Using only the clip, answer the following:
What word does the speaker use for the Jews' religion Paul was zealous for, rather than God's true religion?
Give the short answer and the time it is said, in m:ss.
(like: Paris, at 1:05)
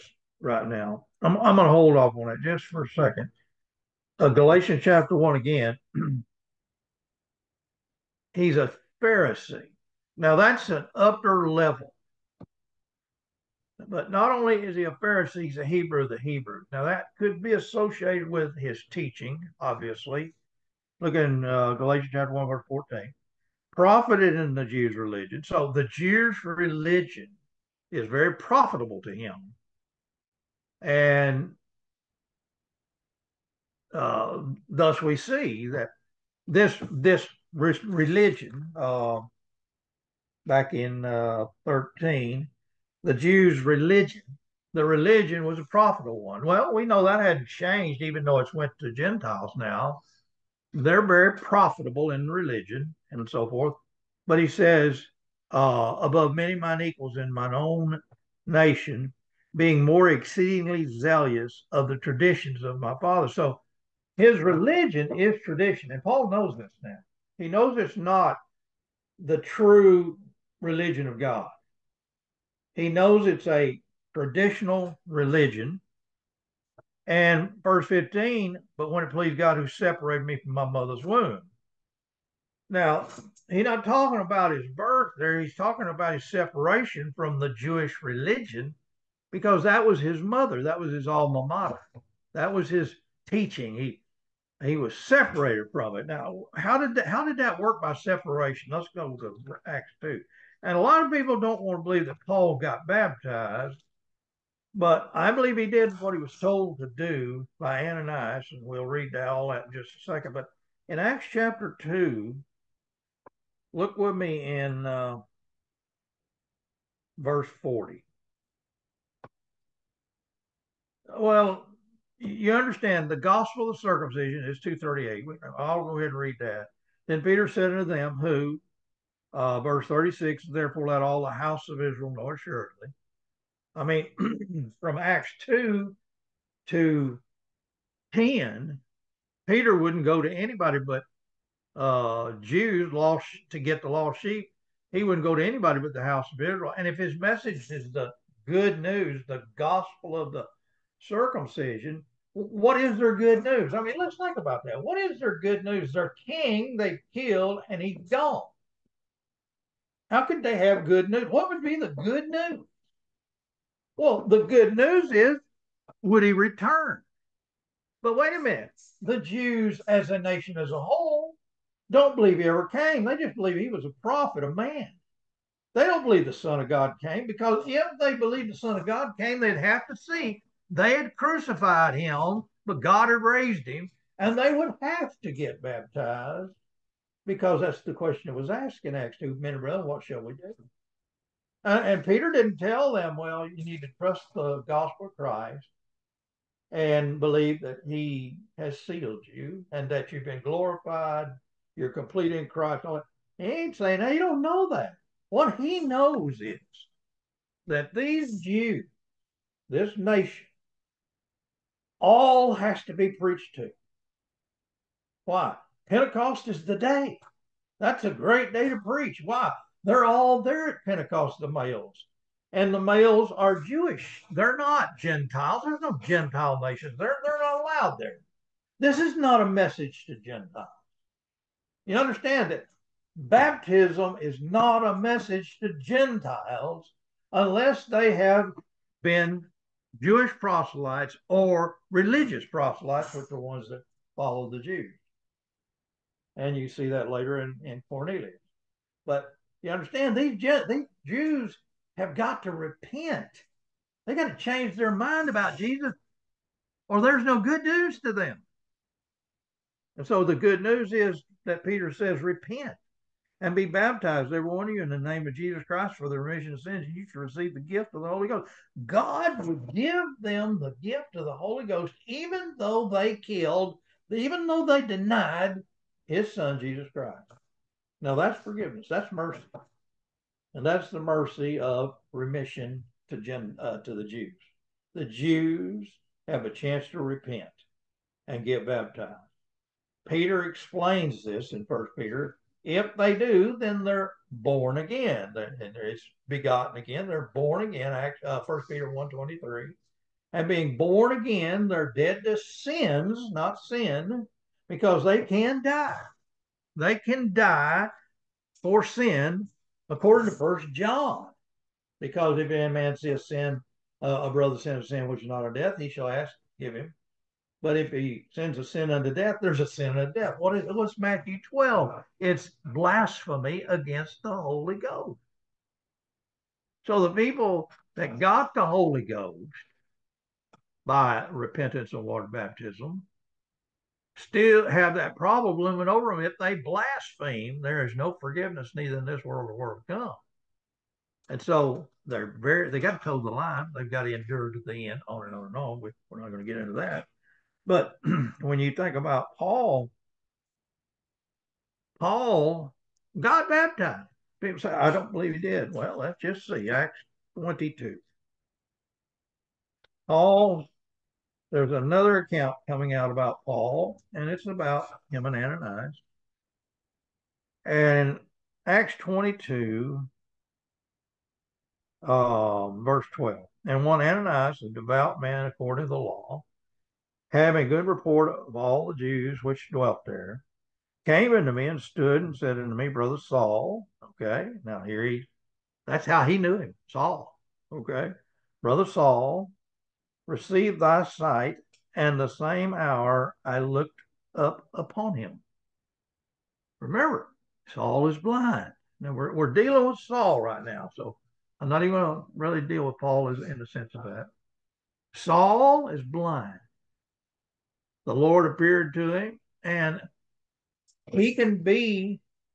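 tradition, at 1:03.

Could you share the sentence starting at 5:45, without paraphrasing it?
We, we're not going to get into that.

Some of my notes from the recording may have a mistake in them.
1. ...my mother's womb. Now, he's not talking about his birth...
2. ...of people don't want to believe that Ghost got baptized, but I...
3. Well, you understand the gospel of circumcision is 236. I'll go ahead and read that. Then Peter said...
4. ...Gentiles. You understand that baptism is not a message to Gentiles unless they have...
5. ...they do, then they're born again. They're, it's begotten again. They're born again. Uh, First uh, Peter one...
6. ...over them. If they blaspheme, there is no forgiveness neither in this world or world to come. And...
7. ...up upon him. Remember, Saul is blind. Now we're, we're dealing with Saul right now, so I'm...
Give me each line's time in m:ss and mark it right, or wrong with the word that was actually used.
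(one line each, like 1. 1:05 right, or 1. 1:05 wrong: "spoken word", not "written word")
1. 1:20 right
2. 1:41 wrong: "Paul", not "Ghost"
3. 2:01 wrong: "238", not "236"
4. 3:50 right
5. 4:52 right
6. 5:35 right
7. 6:34 right.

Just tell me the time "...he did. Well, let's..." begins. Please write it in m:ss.
5:55.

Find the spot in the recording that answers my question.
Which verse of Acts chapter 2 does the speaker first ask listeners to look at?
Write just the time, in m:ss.
1:57.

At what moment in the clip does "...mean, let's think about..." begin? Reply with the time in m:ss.
2:33.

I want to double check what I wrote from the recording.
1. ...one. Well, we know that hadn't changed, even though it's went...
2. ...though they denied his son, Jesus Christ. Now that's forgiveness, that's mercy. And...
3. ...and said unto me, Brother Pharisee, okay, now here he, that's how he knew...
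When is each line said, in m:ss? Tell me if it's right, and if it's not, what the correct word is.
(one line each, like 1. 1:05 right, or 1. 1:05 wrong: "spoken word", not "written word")
1. 0:46 right
2. 4:34 right
3. 6:22 wrong: "Saul", not "Pharisee".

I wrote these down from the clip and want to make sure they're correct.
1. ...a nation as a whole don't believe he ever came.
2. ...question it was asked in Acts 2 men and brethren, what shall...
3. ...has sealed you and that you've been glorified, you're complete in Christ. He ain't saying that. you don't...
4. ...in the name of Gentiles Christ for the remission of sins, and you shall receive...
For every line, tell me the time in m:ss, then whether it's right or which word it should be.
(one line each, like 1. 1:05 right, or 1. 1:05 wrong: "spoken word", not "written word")
1. 2:50 right
2. 3:07 right
3. 3:18 right
4. 4:24 wrong: "Jesus", not "Gentiles".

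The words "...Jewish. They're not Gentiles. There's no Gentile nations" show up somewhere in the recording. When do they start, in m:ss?
3:43.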